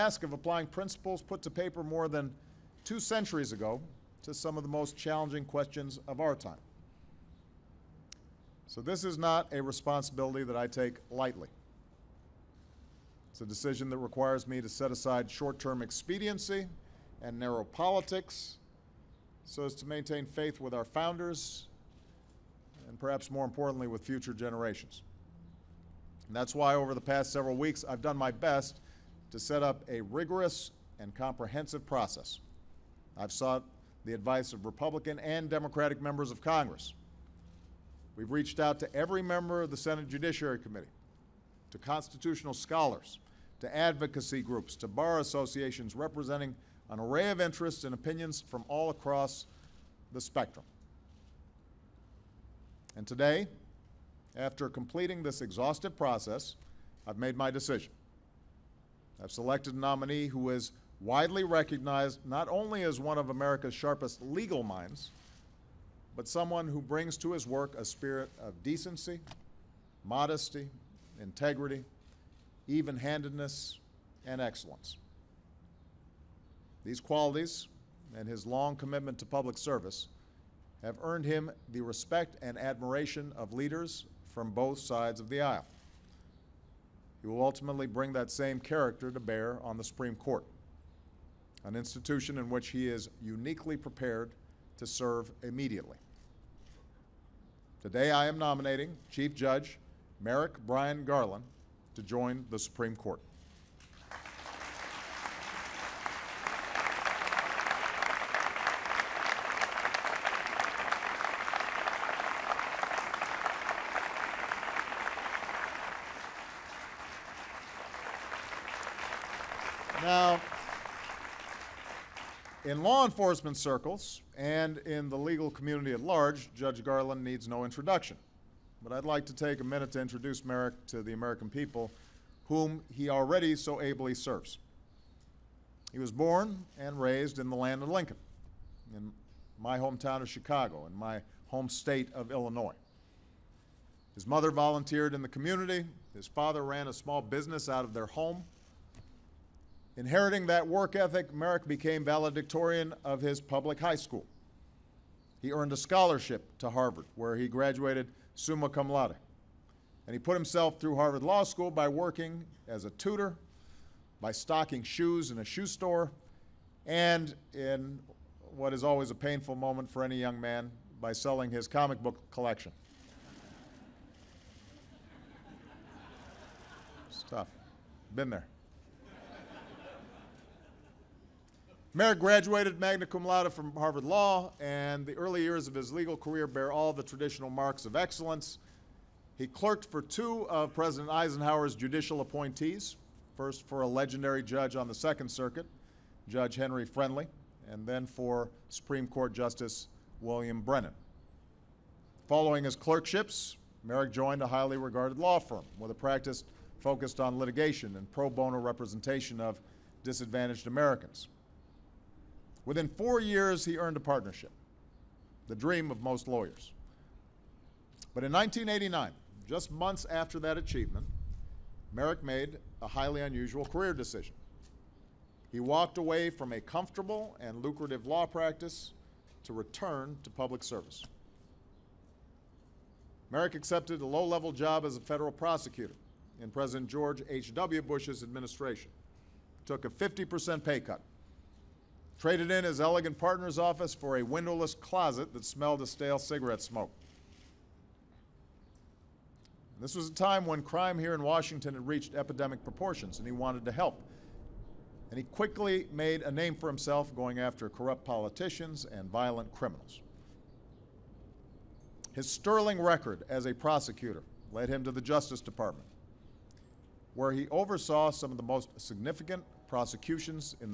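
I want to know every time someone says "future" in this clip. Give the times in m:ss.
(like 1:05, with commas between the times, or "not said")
0:24.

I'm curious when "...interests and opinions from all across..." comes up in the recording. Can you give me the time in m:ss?
0:47.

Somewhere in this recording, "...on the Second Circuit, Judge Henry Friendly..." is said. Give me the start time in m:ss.
3:14.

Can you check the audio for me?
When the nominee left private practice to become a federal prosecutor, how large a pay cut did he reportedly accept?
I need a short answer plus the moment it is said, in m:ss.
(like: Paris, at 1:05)
50%, at 3:59.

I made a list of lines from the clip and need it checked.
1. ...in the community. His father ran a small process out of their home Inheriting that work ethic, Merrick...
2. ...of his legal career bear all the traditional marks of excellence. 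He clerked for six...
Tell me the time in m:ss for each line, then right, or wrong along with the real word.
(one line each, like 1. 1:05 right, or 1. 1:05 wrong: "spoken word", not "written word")
1. 2:25 wrong: "business", not "process"
2. 3:05 wrong: "two", not "six".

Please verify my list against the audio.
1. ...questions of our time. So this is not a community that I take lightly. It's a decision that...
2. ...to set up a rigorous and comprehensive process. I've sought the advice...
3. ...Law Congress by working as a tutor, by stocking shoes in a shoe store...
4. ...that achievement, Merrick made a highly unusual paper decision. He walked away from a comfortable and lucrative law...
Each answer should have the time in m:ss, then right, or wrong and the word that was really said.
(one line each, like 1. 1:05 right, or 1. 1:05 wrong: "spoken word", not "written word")
1. 0:05 wrong: "responsibility", not "community"
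2. 0:29 right
3. 2:41 wrong: "School", not "Congress"
4. 3:40 wrong: "career", not "paper".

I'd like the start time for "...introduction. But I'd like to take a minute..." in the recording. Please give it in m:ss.
2:07.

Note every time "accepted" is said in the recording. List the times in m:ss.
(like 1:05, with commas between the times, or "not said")
3:53.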